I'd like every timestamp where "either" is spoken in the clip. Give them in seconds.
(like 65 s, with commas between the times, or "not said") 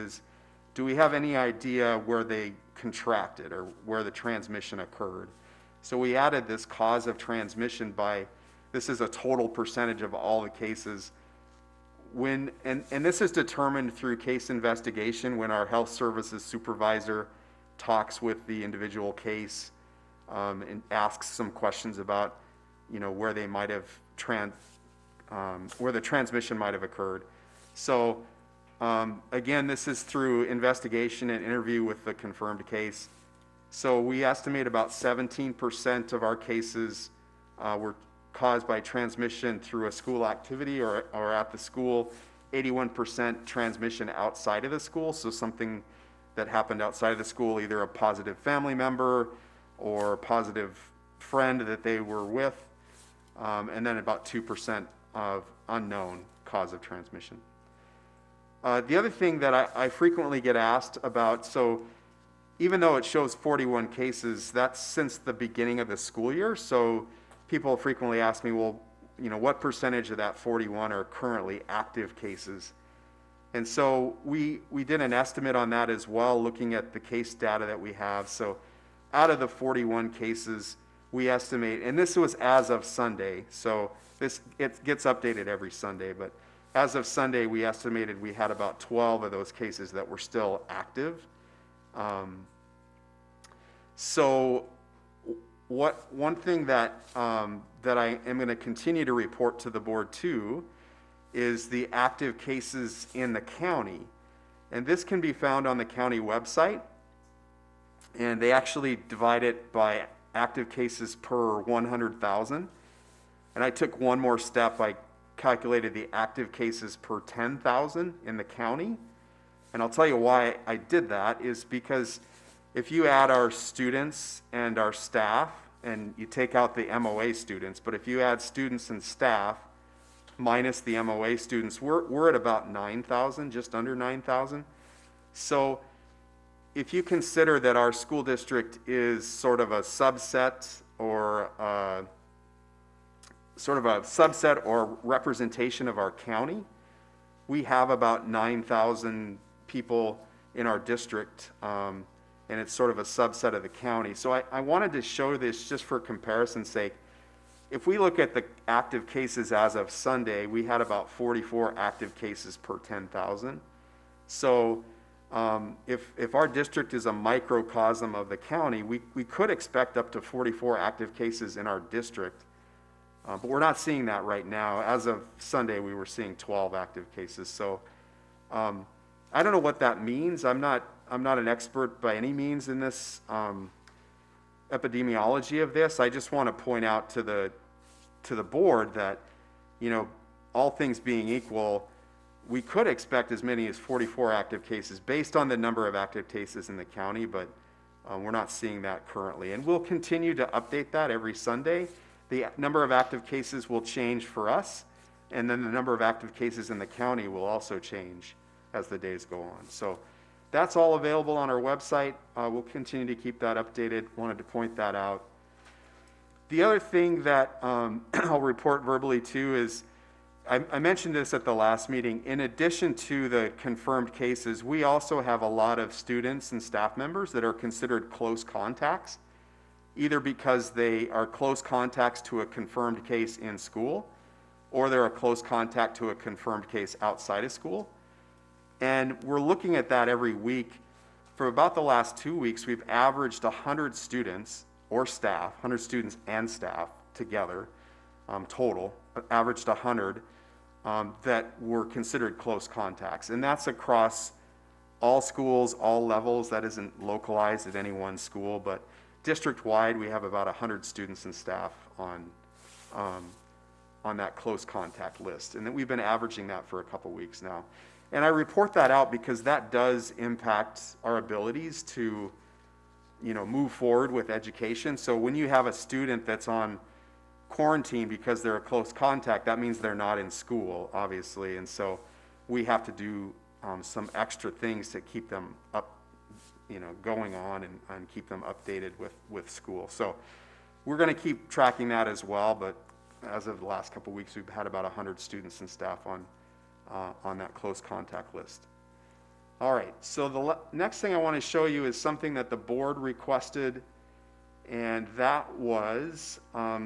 47 s, 229 s.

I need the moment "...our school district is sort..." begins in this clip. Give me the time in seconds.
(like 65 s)
137 s.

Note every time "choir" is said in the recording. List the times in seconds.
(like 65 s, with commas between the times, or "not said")
not said.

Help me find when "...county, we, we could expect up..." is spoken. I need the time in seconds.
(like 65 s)
168 s.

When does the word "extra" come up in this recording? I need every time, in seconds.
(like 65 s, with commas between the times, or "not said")
284 s.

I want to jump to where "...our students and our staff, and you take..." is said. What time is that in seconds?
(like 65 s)
123 s.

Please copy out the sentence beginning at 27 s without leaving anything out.
So um, again, this is through investigation and interview with the confirmed case.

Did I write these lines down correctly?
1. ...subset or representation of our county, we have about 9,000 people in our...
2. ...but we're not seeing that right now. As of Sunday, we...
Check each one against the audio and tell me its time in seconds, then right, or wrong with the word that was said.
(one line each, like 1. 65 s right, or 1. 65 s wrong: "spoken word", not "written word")
1. 143 s right
2. 173 s right.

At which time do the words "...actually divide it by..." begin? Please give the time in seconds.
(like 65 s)
108 s.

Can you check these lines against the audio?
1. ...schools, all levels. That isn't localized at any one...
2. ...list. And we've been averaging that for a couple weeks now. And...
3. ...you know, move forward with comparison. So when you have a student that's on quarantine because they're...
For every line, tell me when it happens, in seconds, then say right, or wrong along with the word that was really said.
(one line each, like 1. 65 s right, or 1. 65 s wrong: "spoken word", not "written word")
1. 255 s right
2. 265 s right
3. 273 s wrong: "education", not "comparison".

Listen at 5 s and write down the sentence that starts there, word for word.
So we added this cause of transmission by, this is a total percentage of all the cases.